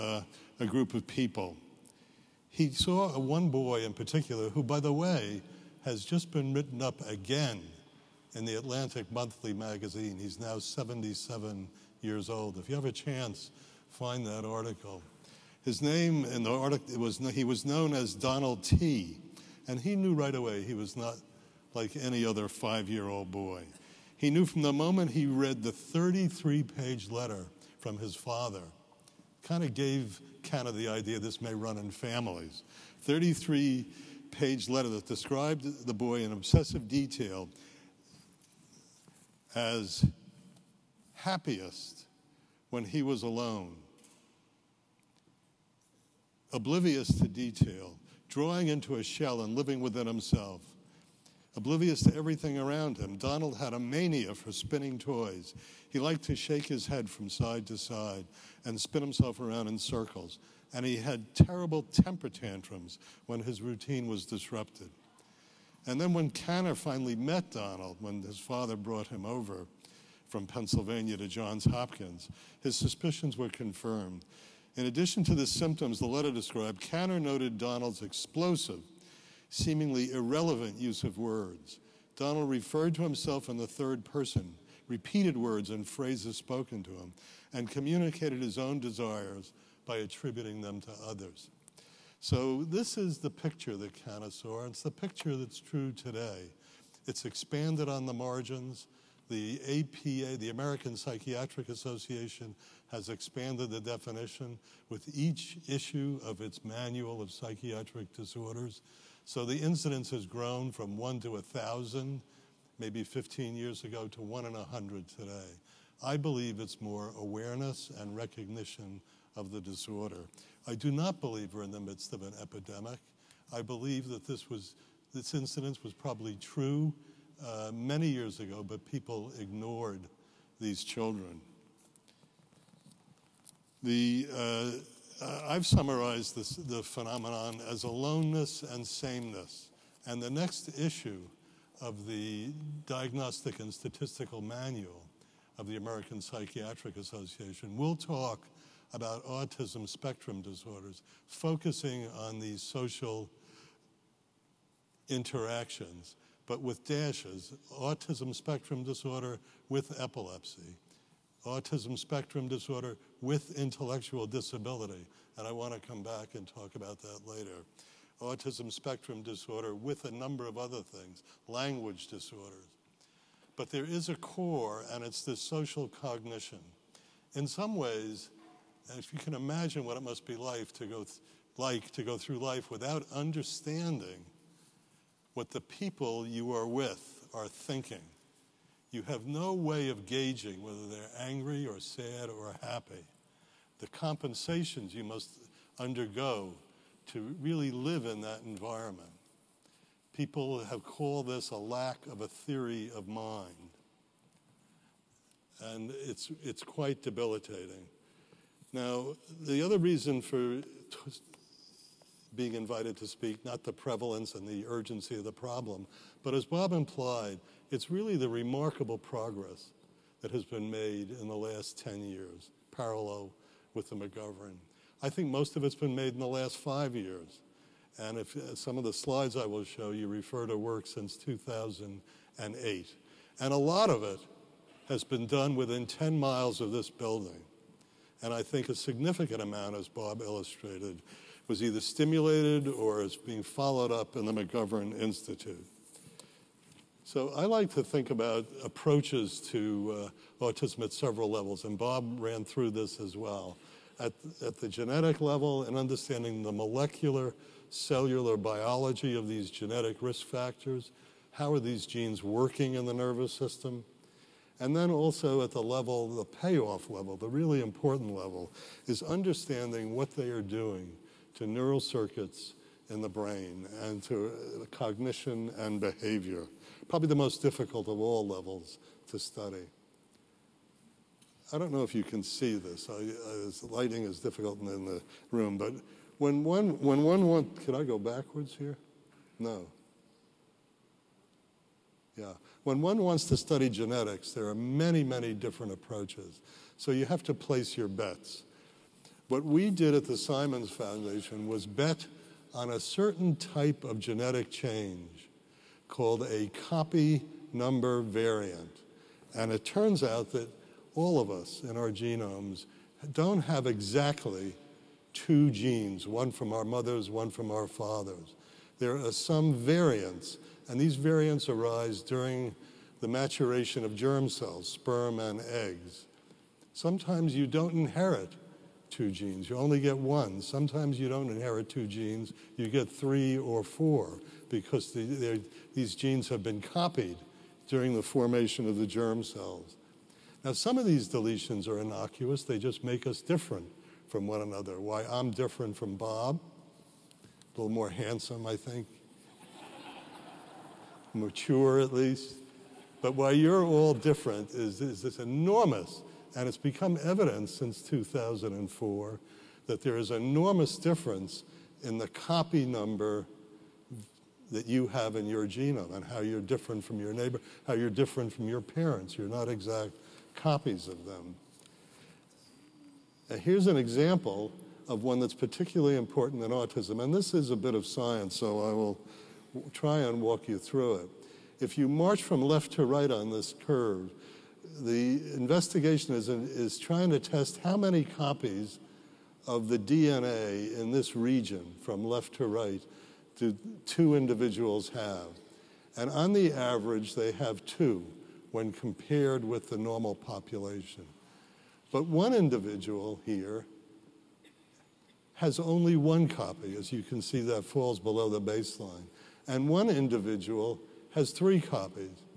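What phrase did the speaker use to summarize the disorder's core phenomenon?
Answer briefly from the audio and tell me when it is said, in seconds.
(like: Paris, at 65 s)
aloneness and sameness, at 137 s.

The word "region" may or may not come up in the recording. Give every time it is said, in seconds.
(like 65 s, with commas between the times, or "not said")
391 s.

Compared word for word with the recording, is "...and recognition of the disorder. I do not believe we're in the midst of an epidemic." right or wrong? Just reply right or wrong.
right.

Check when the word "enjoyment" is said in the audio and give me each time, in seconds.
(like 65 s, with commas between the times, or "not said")
not said.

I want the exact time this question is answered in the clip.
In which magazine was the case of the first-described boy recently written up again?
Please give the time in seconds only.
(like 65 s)
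8 s.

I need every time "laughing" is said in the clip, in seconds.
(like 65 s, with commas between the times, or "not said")
not said.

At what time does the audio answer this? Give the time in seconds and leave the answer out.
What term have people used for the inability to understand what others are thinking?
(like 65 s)
202 s.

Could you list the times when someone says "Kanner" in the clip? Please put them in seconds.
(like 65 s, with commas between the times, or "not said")
66 s, 76 s, 93 s.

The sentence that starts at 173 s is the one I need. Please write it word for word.
But there is a core, and it's this social cognition.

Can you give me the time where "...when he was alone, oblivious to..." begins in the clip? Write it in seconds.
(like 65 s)
42 s.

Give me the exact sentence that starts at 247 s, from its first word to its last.
So I like to think about approaches to uh, autism at several levels, and Bob ran through this as well.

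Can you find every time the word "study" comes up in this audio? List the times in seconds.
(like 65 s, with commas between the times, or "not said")
279 s, 293 s.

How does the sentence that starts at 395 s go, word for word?
And on the average, they have two when compared with the normal population.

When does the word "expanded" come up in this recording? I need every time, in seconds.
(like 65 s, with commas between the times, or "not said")
97 s, 103 s.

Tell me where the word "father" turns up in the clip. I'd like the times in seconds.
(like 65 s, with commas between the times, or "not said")
28 s, 68 s, 317 s.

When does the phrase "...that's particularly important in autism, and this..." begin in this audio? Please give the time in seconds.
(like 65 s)
375 s.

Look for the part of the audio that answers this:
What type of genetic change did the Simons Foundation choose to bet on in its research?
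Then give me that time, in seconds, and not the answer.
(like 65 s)
306 s.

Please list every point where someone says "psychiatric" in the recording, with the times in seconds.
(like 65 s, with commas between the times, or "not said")
100 s, 107 s, 146 s.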